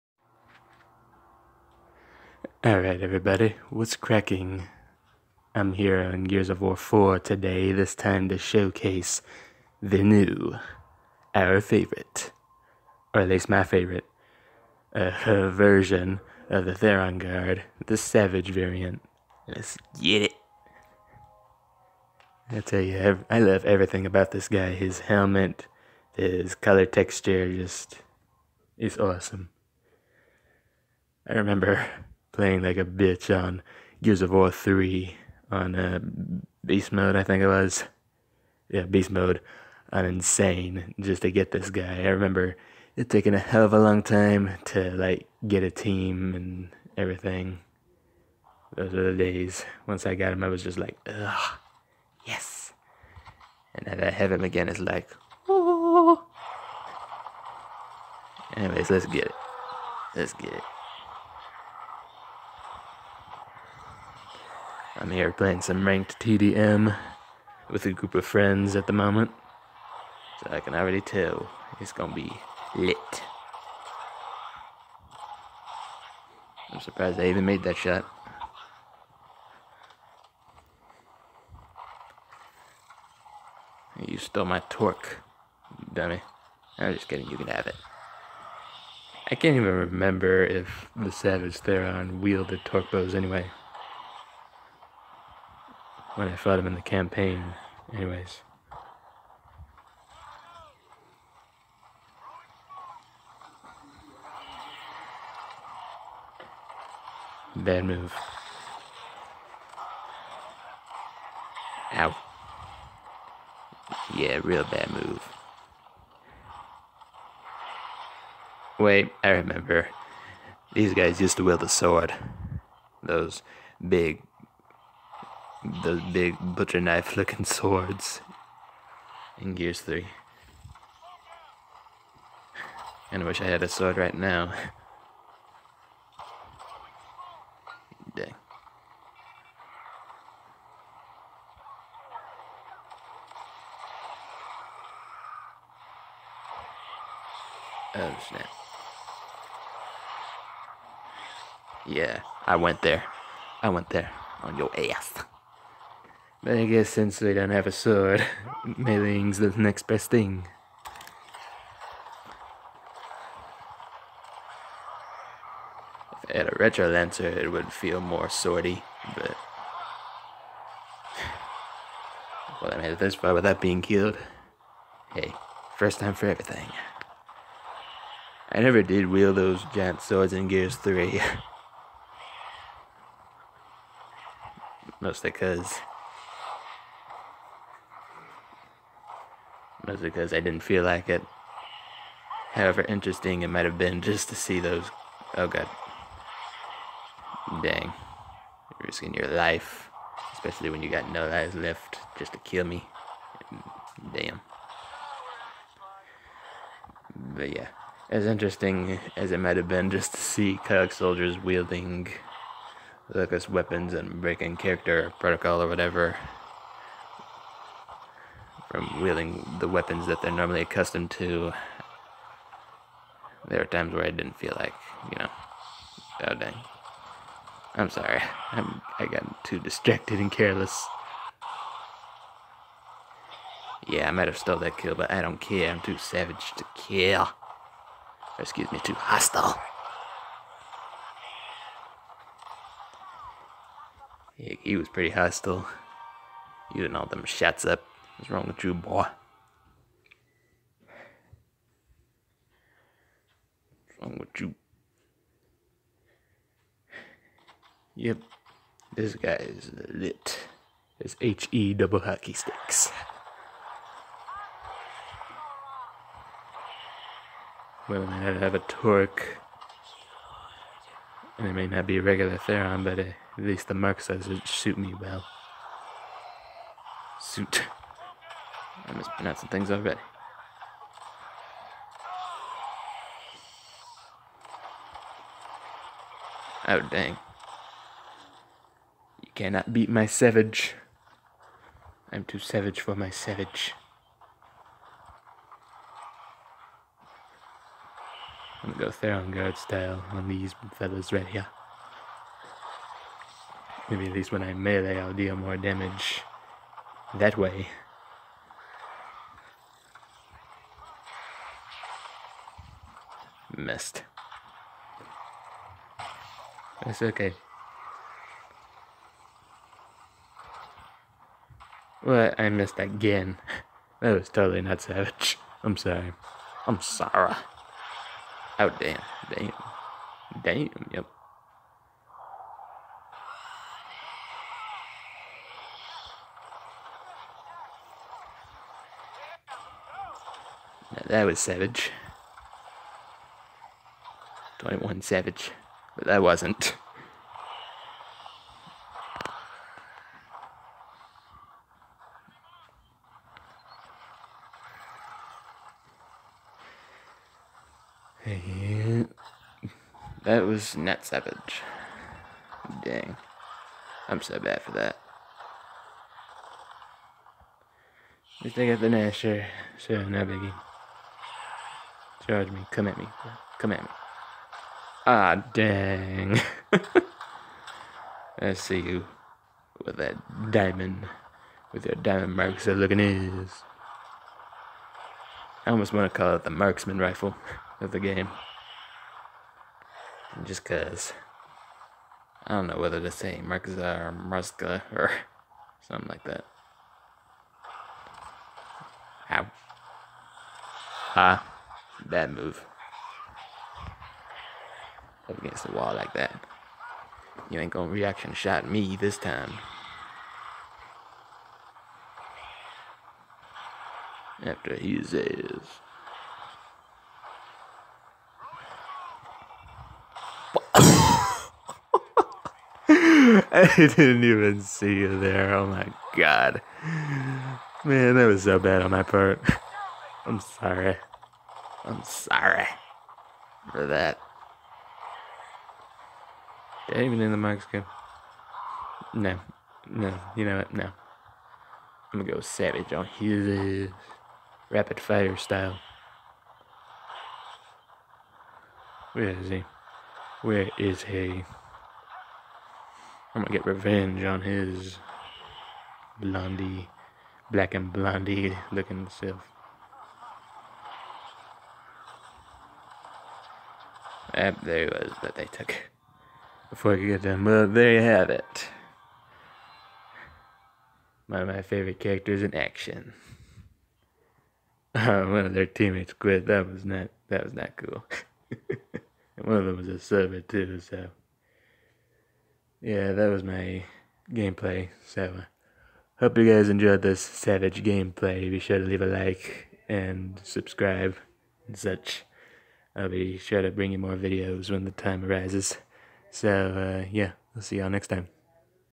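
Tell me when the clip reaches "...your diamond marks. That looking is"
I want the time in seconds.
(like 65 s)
381 s.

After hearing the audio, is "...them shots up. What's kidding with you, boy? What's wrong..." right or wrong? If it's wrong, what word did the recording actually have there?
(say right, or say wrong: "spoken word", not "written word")
wrong: "wrong", not "kidding".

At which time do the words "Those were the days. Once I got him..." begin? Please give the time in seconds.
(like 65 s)
48 s.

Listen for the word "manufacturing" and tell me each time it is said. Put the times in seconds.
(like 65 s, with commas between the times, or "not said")
not said.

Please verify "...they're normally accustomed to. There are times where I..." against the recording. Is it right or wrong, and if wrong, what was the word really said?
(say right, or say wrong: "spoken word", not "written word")
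right.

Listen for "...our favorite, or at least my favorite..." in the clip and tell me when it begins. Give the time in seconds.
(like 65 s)
11 s.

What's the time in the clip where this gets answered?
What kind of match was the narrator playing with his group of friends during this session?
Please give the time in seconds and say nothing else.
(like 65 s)
65 s.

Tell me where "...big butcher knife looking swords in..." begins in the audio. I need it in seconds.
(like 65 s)
126 s.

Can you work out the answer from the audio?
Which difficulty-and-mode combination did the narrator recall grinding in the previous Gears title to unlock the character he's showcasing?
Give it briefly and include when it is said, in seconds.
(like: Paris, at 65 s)
Beast Mode on Insane, at 38 s.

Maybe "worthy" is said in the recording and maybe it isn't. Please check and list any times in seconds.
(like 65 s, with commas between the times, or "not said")
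not said.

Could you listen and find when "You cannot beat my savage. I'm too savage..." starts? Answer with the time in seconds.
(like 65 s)
289 s.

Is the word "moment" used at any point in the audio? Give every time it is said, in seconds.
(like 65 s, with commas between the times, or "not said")
68 s.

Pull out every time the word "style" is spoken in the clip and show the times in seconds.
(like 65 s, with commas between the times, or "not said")
299 s, 445 s.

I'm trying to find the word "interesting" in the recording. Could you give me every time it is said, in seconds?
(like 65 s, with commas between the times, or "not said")
192 s, 208 s.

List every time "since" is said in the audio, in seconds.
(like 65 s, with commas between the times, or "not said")
156 s.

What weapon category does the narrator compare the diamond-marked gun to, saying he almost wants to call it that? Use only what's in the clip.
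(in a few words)
Marksman rifle.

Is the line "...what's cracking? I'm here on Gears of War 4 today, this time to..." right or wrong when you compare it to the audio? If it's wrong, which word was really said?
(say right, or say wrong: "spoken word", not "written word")
right.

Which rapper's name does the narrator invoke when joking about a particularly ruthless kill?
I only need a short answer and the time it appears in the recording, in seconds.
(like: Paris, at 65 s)
21 Savage, at 344 s.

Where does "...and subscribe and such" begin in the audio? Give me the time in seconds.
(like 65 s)
489 s.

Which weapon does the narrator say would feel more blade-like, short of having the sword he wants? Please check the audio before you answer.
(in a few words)
Retro Lancer.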